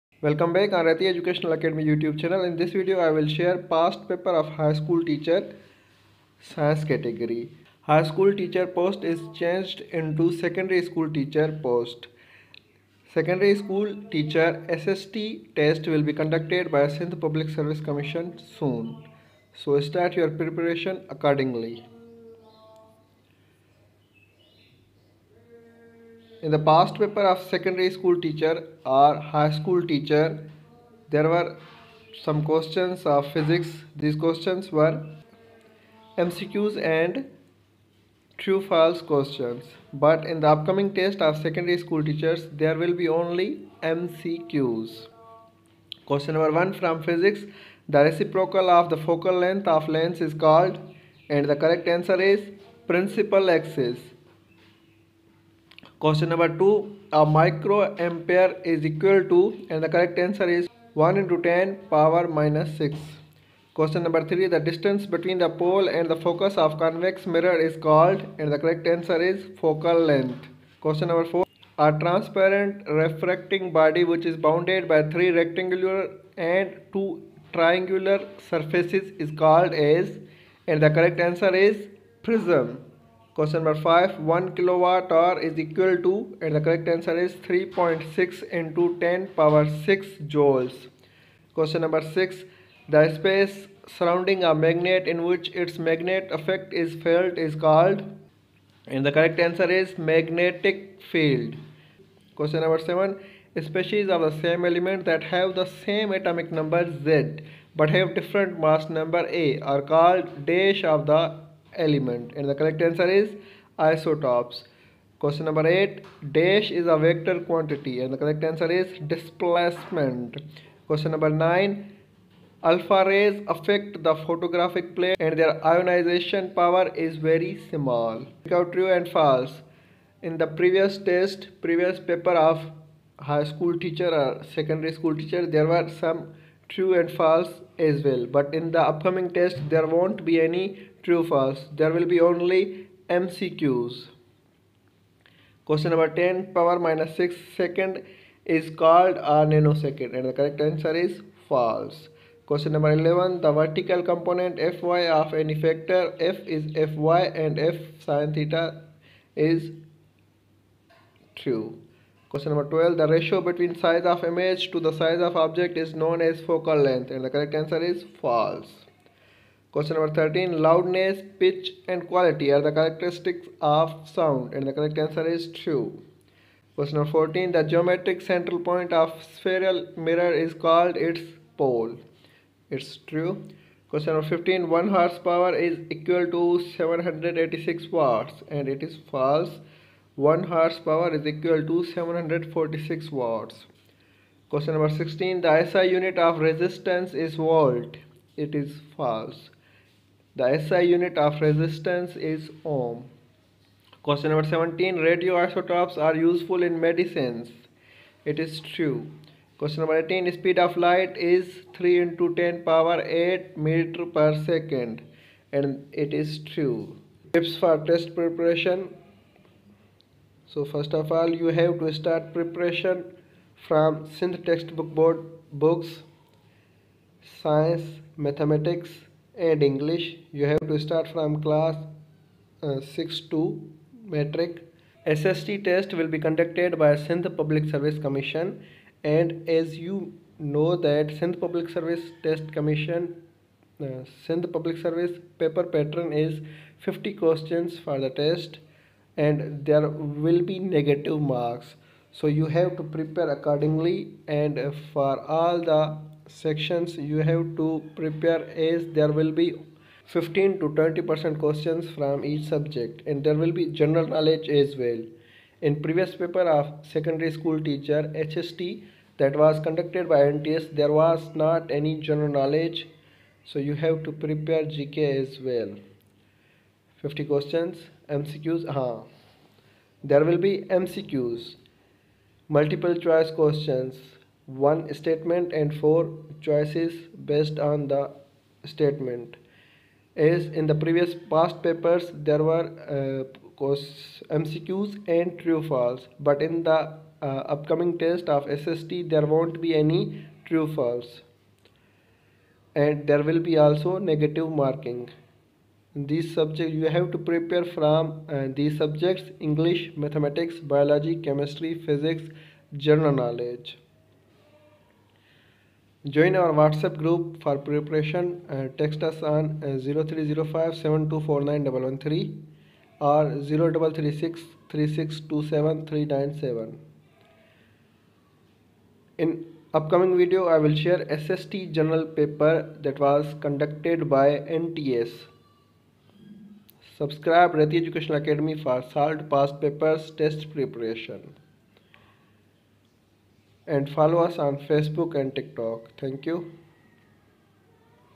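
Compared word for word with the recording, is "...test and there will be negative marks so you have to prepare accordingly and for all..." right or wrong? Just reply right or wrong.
right.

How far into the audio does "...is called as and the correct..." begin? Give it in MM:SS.
01:19.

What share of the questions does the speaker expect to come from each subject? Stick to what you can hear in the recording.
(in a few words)
15 to 20 percent.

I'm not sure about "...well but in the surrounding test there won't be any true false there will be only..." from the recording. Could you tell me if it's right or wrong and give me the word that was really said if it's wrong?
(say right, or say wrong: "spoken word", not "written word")
wrong: "upcoming", not "surrounding".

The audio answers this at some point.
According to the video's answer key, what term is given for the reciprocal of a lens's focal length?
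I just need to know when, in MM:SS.
00:52.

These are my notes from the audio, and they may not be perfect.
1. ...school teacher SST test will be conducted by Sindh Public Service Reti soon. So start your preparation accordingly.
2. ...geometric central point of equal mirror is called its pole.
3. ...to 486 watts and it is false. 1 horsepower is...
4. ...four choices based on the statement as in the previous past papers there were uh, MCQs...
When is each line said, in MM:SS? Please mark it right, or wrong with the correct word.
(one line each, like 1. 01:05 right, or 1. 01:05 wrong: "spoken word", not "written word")
1. 00:13 wrong: "Commission", not "Reti"
2. 02:57 wrong: "spherical", not "equal"
3. 03:06 wrong: "786", not "486"
4. 04:45 right.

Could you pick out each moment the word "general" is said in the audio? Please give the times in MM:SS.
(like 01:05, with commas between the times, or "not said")
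04:23, 04:32, 05:12.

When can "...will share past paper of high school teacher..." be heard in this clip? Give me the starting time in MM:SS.
00:03.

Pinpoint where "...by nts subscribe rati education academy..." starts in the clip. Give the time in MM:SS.
05:34.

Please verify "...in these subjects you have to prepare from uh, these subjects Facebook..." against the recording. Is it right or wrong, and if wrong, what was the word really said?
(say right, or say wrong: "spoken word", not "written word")
wrong: "English", not "Facebook".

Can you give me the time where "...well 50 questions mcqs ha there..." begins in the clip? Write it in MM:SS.
04:35.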